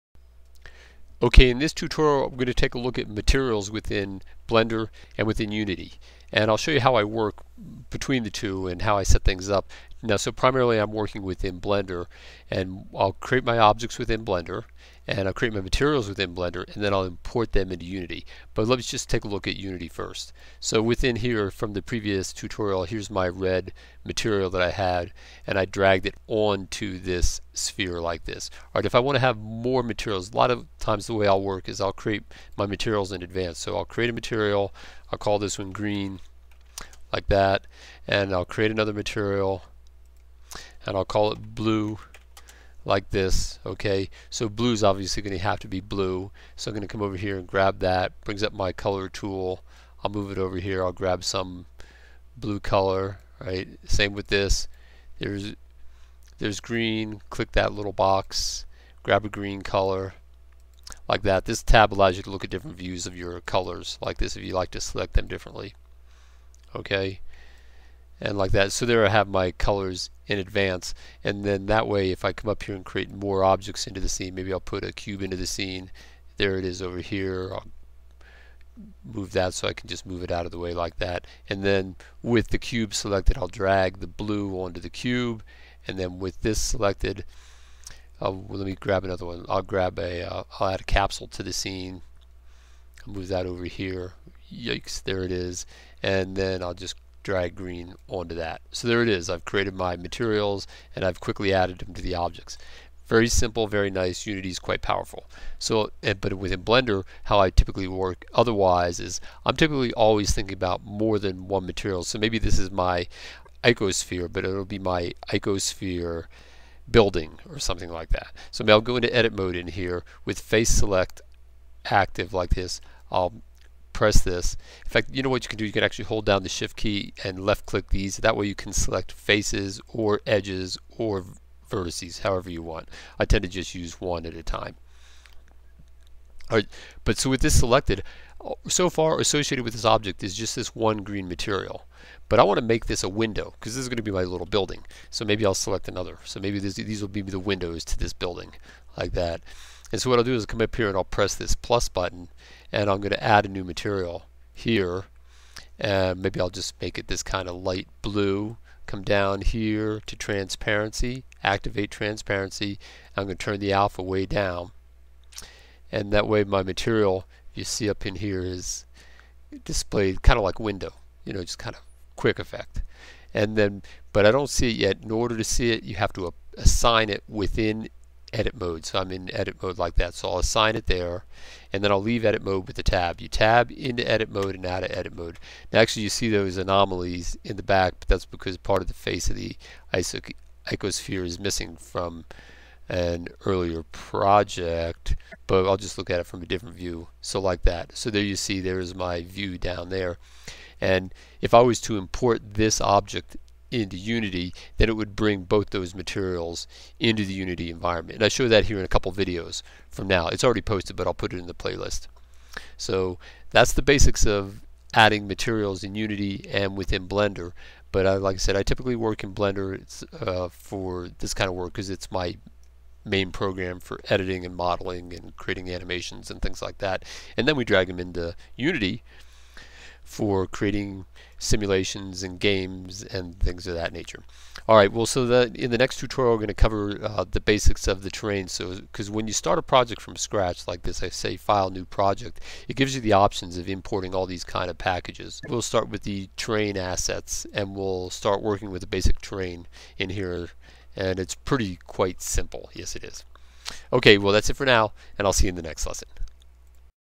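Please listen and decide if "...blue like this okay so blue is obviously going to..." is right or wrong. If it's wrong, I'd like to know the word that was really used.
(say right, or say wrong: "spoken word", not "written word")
right.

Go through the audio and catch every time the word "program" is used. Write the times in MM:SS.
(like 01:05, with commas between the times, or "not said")
03:43.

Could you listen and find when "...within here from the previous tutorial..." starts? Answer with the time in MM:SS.
00:20.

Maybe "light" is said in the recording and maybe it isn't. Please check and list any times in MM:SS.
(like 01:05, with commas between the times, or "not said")
02:37.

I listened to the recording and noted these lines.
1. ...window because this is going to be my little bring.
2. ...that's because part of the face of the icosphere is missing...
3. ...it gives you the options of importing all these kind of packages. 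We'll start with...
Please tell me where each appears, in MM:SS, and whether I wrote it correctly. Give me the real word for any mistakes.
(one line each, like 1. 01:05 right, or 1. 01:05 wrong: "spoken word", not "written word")
1. 02:23 wrong: "building", not "bring"
2. 03:08 right
3. 04:02 right.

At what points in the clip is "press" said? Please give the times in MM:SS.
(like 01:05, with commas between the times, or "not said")
02:04, 02:31.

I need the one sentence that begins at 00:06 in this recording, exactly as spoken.
And I'll show you how I work between the two and how I set things up.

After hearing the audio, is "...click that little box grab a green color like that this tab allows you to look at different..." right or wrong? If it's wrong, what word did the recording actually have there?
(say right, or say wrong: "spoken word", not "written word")
right.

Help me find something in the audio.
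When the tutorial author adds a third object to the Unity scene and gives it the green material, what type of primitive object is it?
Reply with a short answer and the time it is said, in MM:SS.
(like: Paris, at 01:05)
Capsule, at 01:30.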